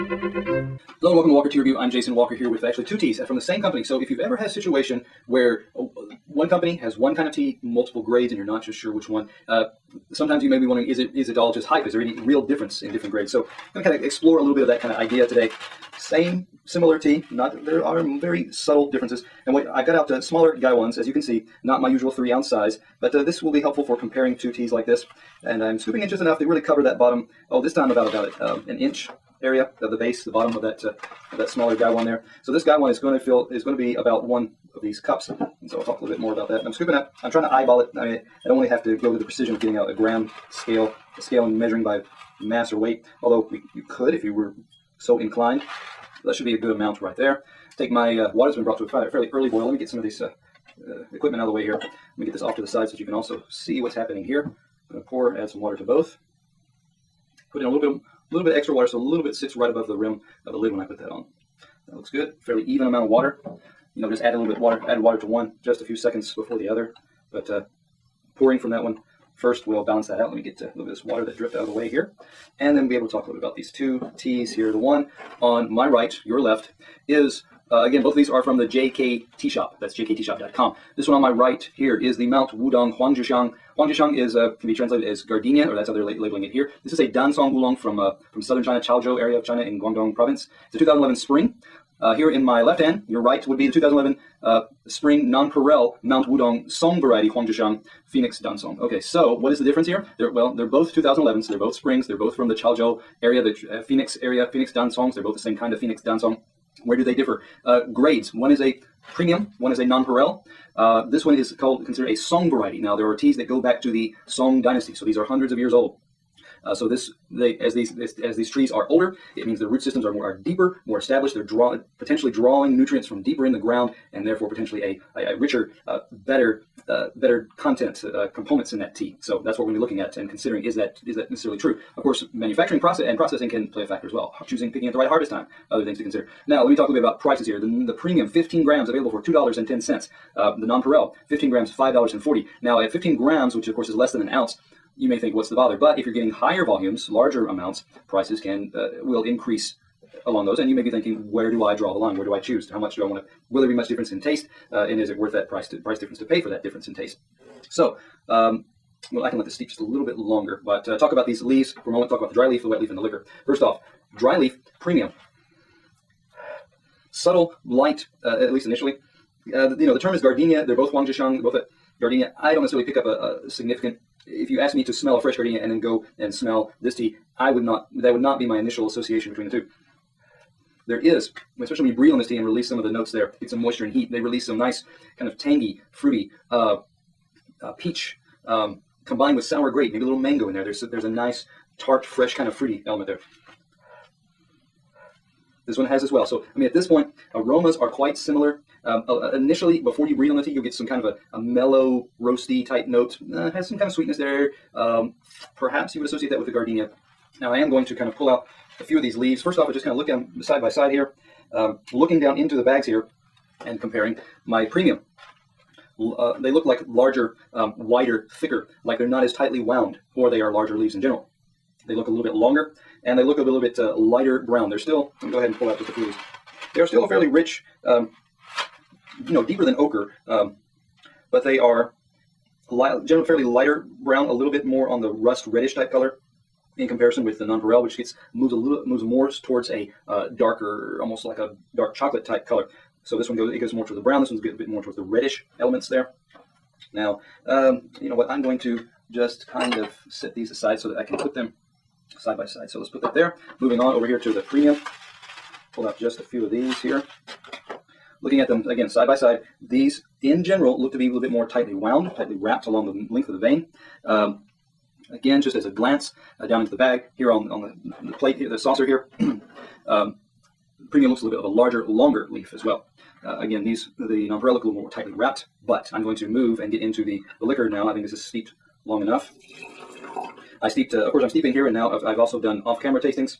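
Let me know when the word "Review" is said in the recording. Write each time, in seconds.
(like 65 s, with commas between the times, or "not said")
1 s.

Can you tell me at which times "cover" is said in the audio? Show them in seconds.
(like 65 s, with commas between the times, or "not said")
26 s.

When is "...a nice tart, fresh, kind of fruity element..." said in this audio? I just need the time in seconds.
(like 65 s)
191 s.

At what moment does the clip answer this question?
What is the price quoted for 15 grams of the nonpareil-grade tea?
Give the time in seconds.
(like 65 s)
141 s.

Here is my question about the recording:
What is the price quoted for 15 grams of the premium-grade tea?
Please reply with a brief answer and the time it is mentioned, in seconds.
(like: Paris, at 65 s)
$2.10, at 139 s.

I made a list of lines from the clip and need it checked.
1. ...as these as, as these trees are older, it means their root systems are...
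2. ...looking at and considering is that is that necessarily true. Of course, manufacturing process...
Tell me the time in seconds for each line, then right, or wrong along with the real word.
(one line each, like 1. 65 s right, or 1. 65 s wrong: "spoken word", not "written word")
1. 117 s right
2. 129 s right.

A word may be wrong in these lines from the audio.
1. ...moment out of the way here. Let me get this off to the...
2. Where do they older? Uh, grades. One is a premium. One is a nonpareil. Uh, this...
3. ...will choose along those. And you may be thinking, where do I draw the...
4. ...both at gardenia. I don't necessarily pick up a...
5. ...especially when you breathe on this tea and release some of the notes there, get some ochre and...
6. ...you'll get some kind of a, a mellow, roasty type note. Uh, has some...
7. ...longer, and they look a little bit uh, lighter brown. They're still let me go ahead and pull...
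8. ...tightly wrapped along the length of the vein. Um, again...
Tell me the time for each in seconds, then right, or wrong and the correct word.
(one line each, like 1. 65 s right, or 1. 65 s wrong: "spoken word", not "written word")
1. 51 s wrong: "equipment", not "moment"
2. 106 s wrong: "differ", not "older"
3. 149 s wrong: "increase", not "choose"
4. 171 s right
5. 181 s wrong: "moisture", not "ochre"
6. 200 s right
7. 222 s right
8. 262 s right.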